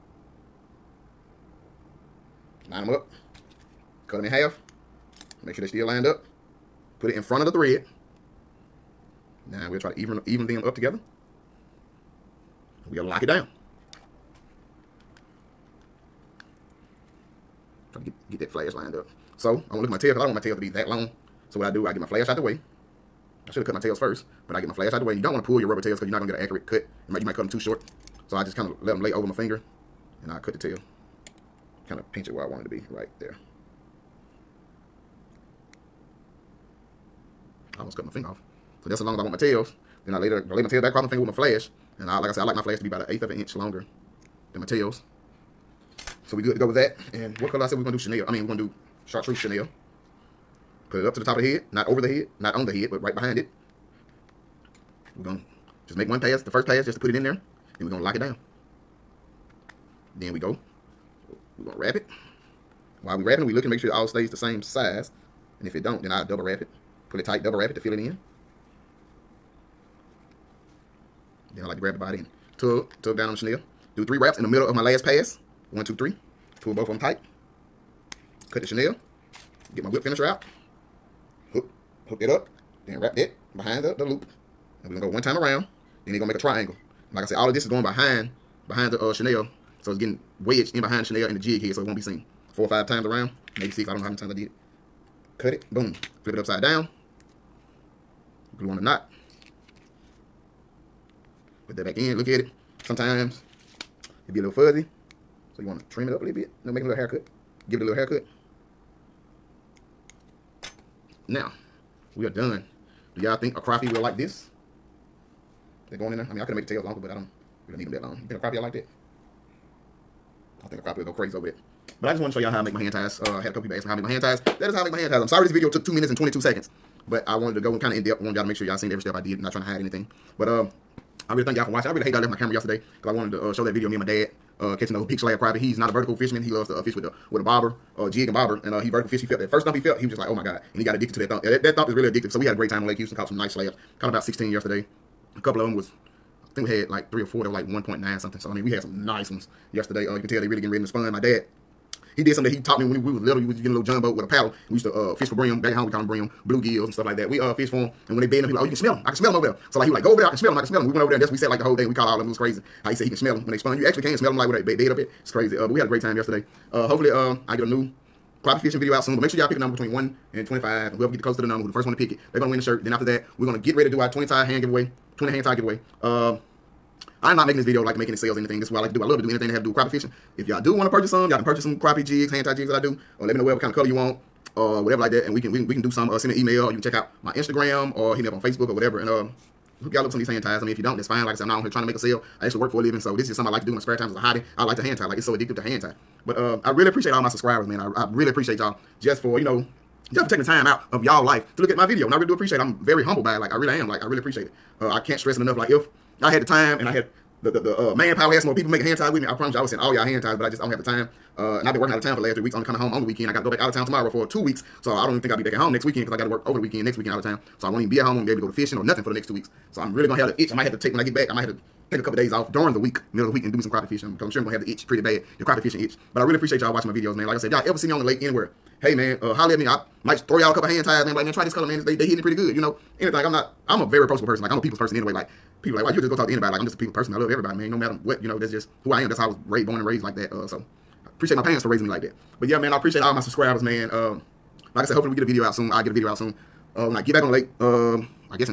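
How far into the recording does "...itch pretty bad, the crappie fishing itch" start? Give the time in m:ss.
3:44.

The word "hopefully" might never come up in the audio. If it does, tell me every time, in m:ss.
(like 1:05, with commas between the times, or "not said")
2:46, 4:04.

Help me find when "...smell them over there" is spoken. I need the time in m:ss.
2:39.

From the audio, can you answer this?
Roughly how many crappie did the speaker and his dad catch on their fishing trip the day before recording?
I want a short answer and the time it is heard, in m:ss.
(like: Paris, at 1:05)
16, at 2:24.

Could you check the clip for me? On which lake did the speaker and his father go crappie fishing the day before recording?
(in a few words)
Lake Houston.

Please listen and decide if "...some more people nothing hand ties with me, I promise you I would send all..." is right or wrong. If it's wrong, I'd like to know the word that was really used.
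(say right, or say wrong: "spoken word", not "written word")
wrong: "making", not "nothing".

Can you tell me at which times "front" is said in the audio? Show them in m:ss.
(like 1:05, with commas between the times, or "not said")
0:07.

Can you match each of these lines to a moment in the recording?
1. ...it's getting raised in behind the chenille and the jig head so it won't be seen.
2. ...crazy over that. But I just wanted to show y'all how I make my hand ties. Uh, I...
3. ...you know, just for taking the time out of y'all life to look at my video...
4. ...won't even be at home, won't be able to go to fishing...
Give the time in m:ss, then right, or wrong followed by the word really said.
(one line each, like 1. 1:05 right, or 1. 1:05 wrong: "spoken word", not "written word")
1. 1:29 wrong: "wedged", not "raised"
2. 2:01 right
3. 3:19 right
4. 3:37 right.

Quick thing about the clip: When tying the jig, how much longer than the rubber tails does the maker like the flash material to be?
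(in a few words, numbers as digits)
1/8 inch.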